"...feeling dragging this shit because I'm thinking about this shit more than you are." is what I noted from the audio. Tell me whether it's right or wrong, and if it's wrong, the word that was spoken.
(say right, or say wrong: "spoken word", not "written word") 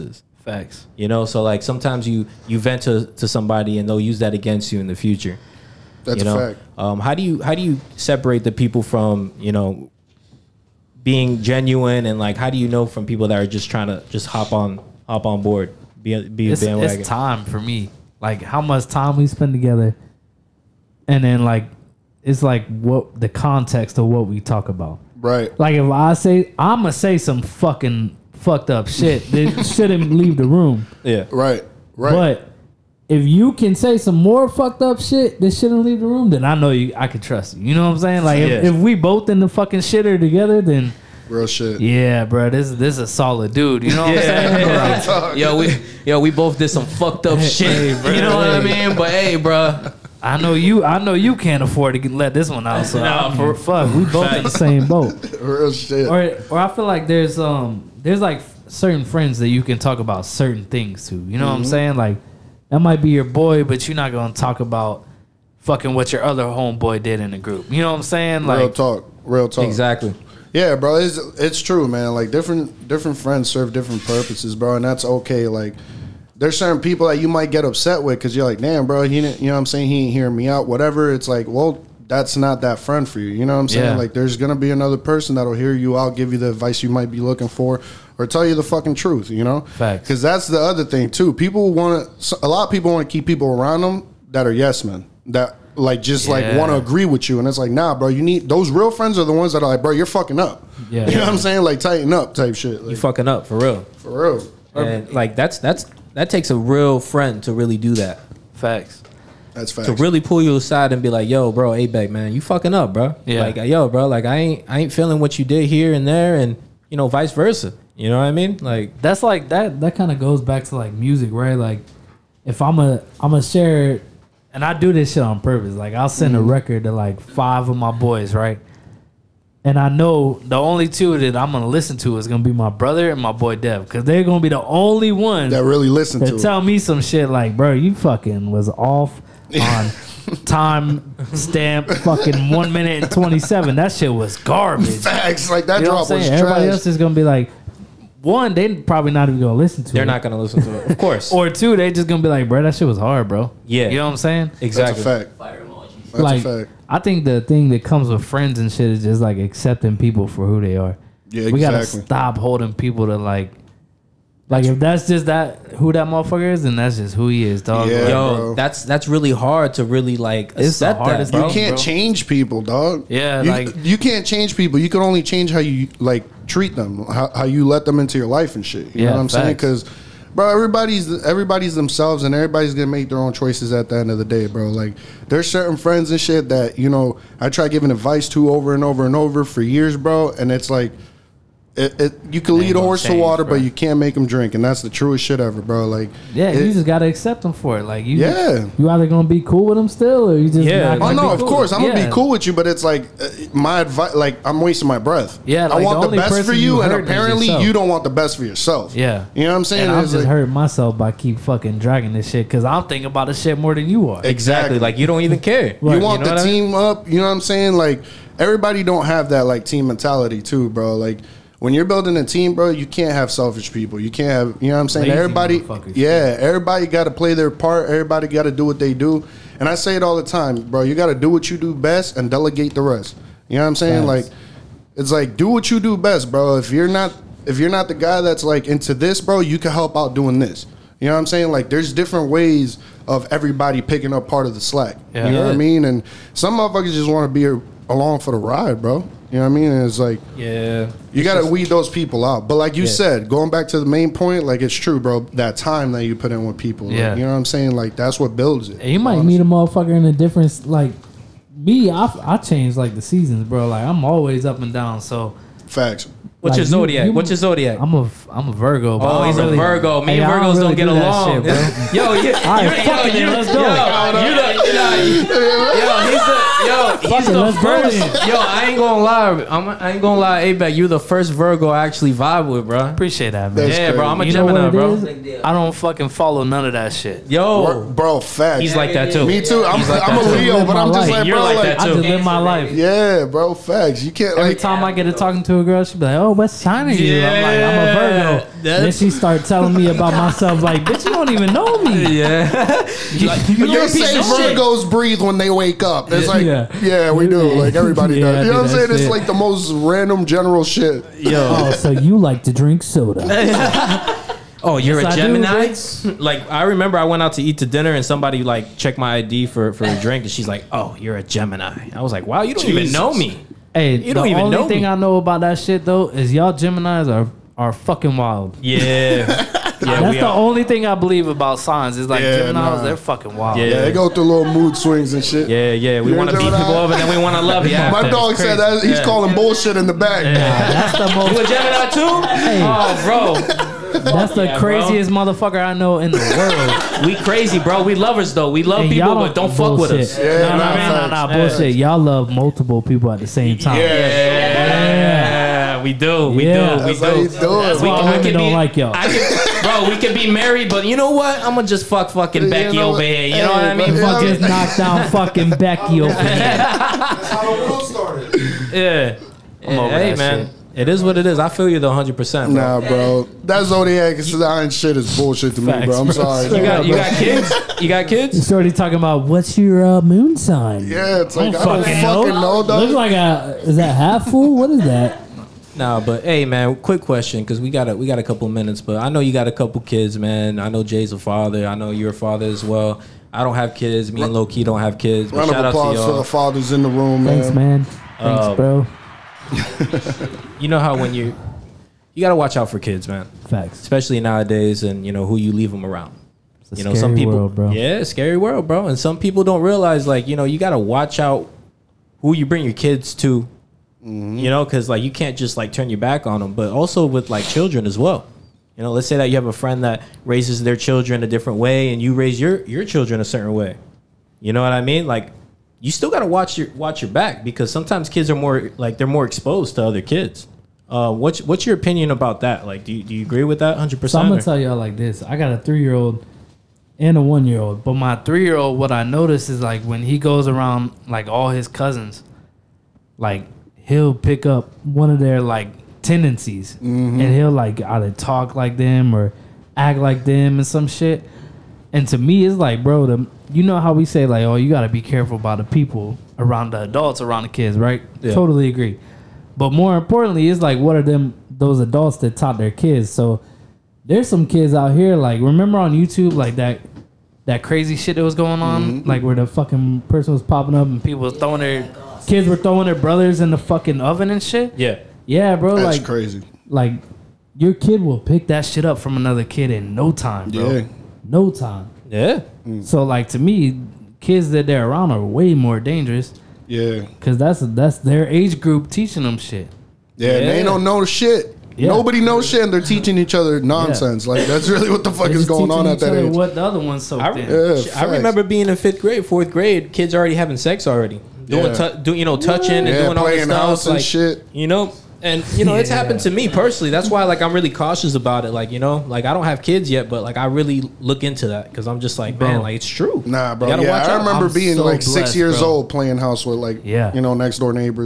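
wrong: "fucking", not "feeling".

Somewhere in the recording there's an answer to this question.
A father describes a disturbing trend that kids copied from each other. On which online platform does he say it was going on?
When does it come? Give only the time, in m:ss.
7:45.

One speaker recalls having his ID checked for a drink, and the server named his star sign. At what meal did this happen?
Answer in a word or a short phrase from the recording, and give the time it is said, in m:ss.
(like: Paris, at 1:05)
dinner, at 5:17.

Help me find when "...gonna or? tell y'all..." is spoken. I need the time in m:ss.
7:14.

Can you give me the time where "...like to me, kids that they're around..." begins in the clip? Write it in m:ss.
8:03.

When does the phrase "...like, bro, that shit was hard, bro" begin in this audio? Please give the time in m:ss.
2:32.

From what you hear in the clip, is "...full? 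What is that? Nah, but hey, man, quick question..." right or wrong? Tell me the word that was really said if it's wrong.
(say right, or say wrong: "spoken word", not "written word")
right.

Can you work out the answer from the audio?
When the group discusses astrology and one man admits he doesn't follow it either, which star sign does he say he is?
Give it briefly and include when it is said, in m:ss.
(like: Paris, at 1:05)
Leo, at 4:50.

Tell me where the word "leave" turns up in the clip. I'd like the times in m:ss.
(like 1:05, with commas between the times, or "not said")
0:30, 0:35, 6:45.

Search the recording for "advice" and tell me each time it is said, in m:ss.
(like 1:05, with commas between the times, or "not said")
1:26, 3:07, 3:23.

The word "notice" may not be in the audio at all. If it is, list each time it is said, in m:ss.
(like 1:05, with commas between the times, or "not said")
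7:19.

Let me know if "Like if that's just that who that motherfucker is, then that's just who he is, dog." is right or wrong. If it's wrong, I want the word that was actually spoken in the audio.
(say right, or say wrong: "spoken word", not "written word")
right.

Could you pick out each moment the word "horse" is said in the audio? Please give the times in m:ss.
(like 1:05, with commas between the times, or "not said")
3:12.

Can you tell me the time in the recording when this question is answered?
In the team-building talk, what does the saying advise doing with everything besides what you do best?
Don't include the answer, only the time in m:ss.
3:52.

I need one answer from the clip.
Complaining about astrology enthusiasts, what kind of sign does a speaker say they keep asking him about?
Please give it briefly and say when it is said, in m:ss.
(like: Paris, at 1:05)
moon sign, at 6:20.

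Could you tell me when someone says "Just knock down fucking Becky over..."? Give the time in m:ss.
6:04.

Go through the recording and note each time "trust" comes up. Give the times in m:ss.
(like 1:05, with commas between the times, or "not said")
0:37.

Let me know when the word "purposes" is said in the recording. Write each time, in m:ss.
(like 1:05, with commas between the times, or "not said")
1:14, 2:05.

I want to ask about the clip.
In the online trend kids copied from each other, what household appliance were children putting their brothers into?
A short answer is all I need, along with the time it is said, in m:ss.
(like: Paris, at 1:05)
oven, at 7:54.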